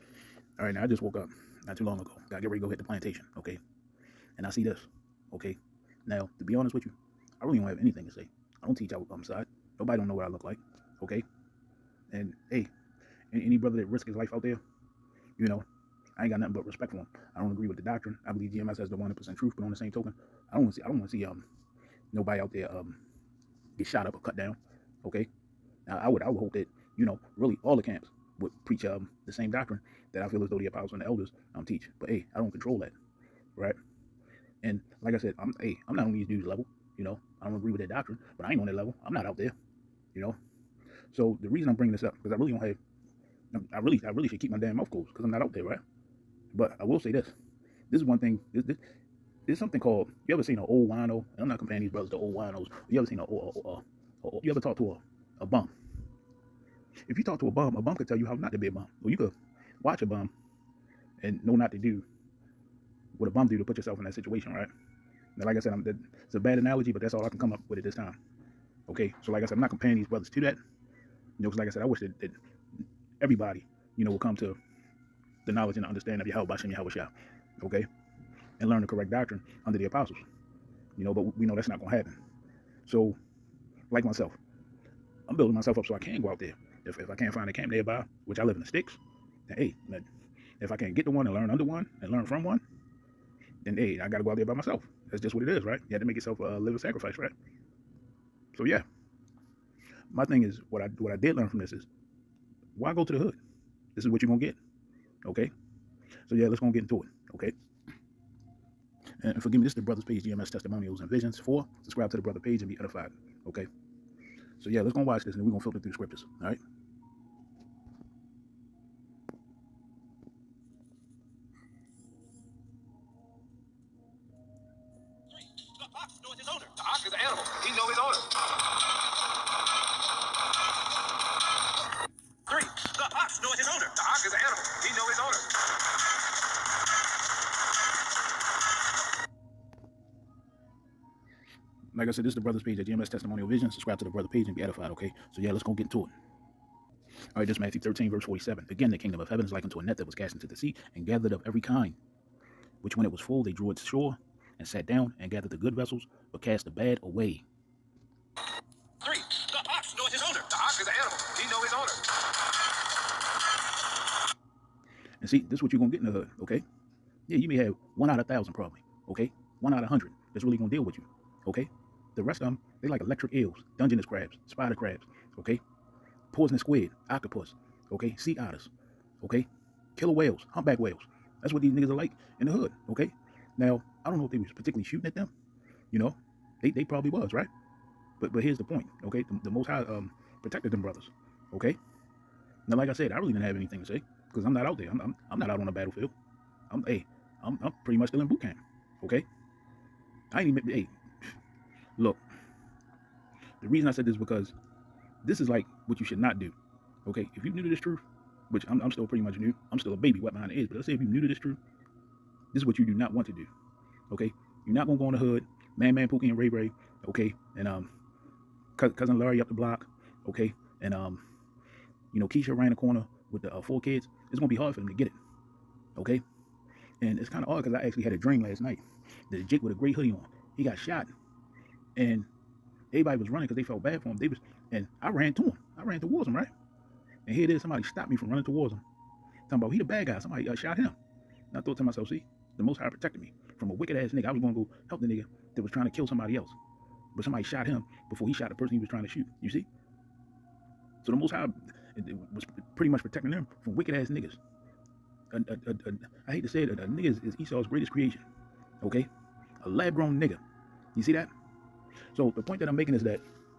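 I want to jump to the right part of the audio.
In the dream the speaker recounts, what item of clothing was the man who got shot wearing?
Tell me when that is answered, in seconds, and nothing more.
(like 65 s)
229 s.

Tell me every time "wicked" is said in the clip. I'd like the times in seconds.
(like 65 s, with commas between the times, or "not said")
243 s, 253 s.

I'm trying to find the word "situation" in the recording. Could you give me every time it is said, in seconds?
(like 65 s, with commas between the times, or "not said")
64 s.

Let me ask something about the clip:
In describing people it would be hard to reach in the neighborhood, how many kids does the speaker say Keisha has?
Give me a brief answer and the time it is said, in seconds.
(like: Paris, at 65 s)
4, at 223 s.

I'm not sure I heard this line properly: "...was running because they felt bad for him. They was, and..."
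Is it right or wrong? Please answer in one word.
right.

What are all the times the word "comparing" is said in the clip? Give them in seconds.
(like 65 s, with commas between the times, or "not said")
51 s, 69 s.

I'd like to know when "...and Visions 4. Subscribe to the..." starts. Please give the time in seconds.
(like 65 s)
110 s.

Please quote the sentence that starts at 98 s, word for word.
So yeah, my thing is what I what I did learn from this is why go to the hood?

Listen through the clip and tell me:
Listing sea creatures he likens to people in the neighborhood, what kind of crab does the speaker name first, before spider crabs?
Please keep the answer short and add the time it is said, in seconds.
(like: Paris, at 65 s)
Dungeness crabs, at 173 s.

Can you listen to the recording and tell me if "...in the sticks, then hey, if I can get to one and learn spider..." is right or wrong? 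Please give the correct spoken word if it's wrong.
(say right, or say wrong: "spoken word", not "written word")
wrong: "under", not "spider".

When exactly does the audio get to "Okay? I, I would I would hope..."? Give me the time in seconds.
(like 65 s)
25 s.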